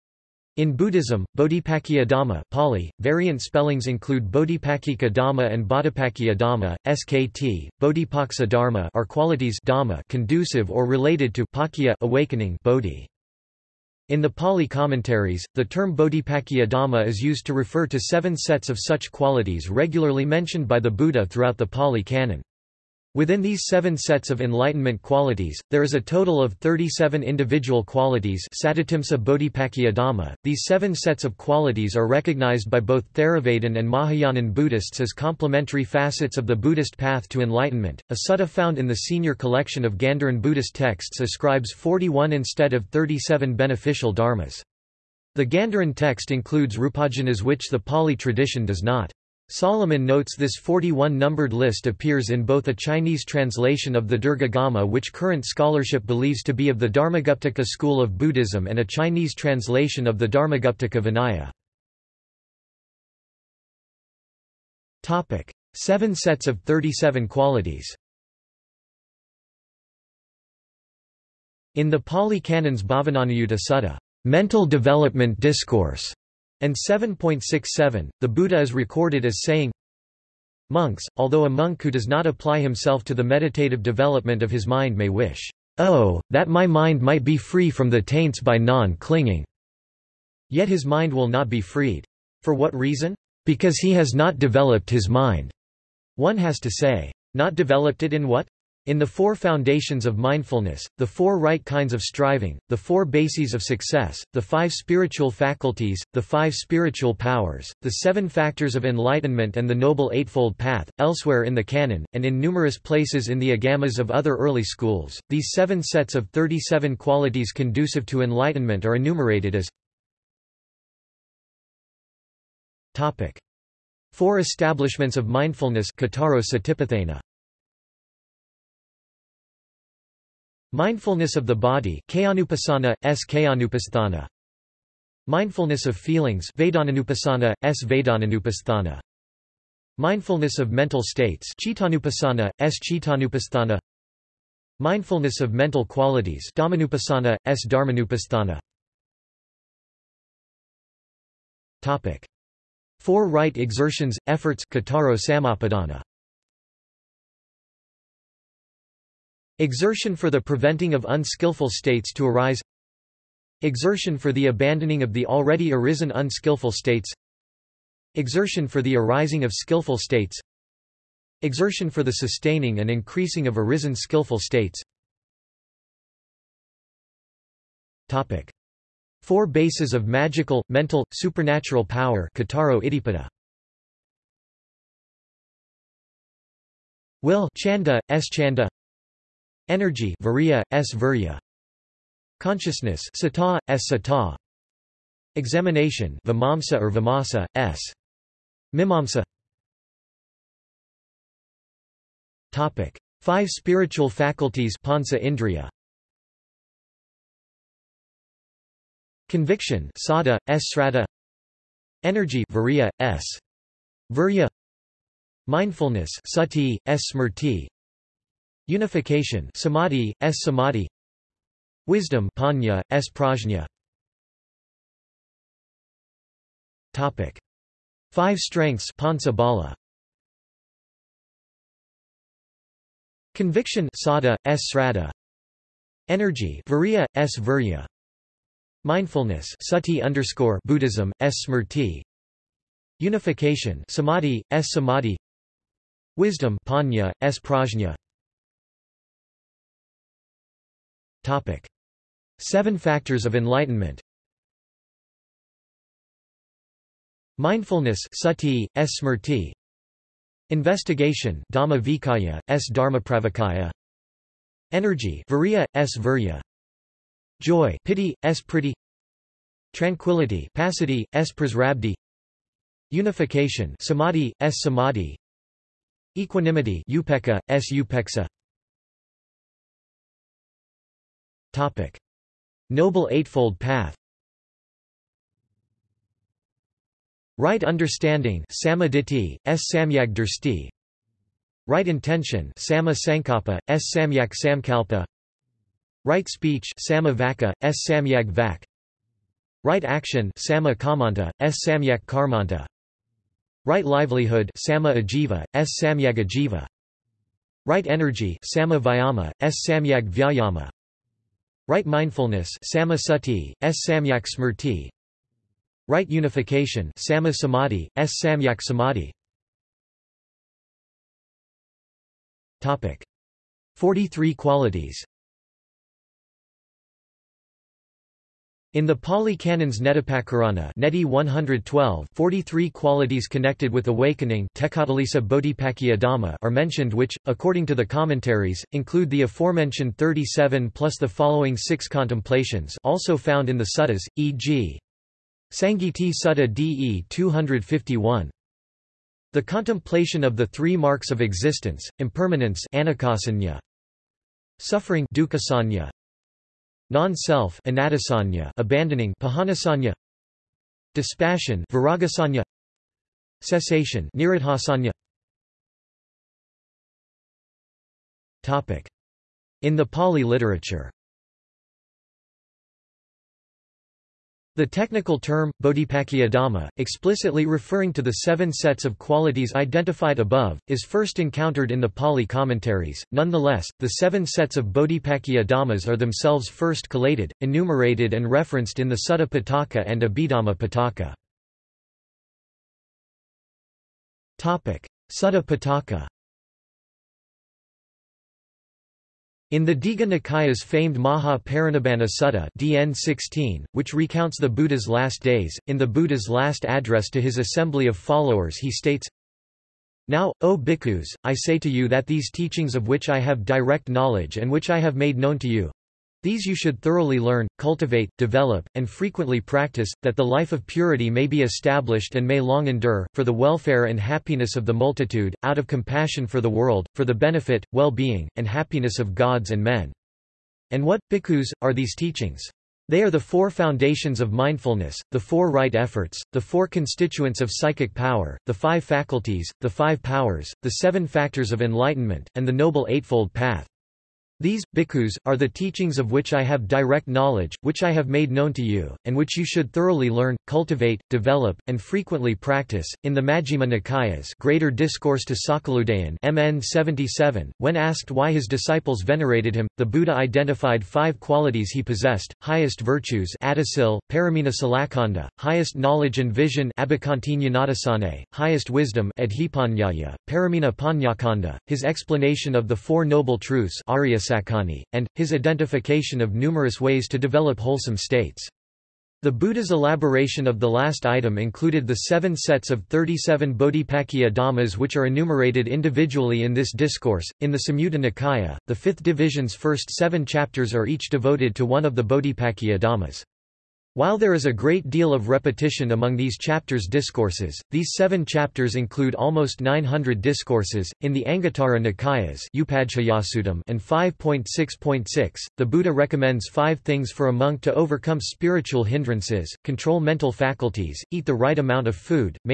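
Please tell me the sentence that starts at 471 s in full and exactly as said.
His explanation of the Four Noble Truths and, his identification of numerous ways to develop wholesome states.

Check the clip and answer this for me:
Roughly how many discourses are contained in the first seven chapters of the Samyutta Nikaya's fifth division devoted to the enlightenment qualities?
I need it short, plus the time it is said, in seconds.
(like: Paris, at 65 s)
almost 900, at 499 s.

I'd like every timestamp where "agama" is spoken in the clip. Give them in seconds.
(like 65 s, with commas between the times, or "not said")
54 s, 113 s.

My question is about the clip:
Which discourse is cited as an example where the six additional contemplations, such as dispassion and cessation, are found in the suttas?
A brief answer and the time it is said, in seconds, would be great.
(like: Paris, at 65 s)
Sangiti Sutta, at 345 s.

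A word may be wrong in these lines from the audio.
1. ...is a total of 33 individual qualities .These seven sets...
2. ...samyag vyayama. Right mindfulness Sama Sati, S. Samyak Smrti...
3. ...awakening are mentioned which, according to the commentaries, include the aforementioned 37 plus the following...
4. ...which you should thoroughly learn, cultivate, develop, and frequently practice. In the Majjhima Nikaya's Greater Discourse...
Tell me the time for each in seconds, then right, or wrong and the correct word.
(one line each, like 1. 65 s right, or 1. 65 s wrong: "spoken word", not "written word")
1. 25 s wrong: "37", not "33"
2. 309 s right
3. 333 s right
4. 449 s right.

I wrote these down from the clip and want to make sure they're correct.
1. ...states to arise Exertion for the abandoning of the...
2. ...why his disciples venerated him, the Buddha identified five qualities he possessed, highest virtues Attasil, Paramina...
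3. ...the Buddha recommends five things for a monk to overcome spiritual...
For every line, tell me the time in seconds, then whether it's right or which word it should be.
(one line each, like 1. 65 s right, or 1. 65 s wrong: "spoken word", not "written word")
1. 161 s right
2. 458 s right
3. 505 s right.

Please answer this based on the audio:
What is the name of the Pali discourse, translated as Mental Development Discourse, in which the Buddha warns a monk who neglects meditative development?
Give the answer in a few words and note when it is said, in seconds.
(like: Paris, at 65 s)
Bhavananuyutta Sutta, at 72 s.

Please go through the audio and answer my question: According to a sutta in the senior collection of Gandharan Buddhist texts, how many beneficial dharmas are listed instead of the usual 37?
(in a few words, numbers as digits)
41.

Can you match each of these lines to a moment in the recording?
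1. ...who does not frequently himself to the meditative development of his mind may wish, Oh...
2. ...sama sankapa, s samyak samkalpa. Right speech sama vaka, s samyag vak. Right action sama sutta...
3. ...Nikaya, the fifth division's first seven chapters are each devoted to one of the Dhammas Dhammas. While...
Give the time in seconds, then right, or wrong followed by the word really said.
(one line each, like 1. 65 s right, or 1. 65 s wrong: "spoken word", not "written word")
1. 81 s wrong: "apply", not "frequently"
2. 292 s wrong: "kamanta", not "sutta"
3. 487 s wrong: "Bodhipakkhiya", not "Dhammas".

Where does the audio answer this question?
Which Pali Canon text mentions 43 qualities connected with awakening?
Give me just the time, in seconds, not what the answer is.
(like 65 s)
329 s.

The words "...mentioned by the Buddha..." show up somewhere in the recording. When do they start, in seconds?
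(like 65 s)
20 s.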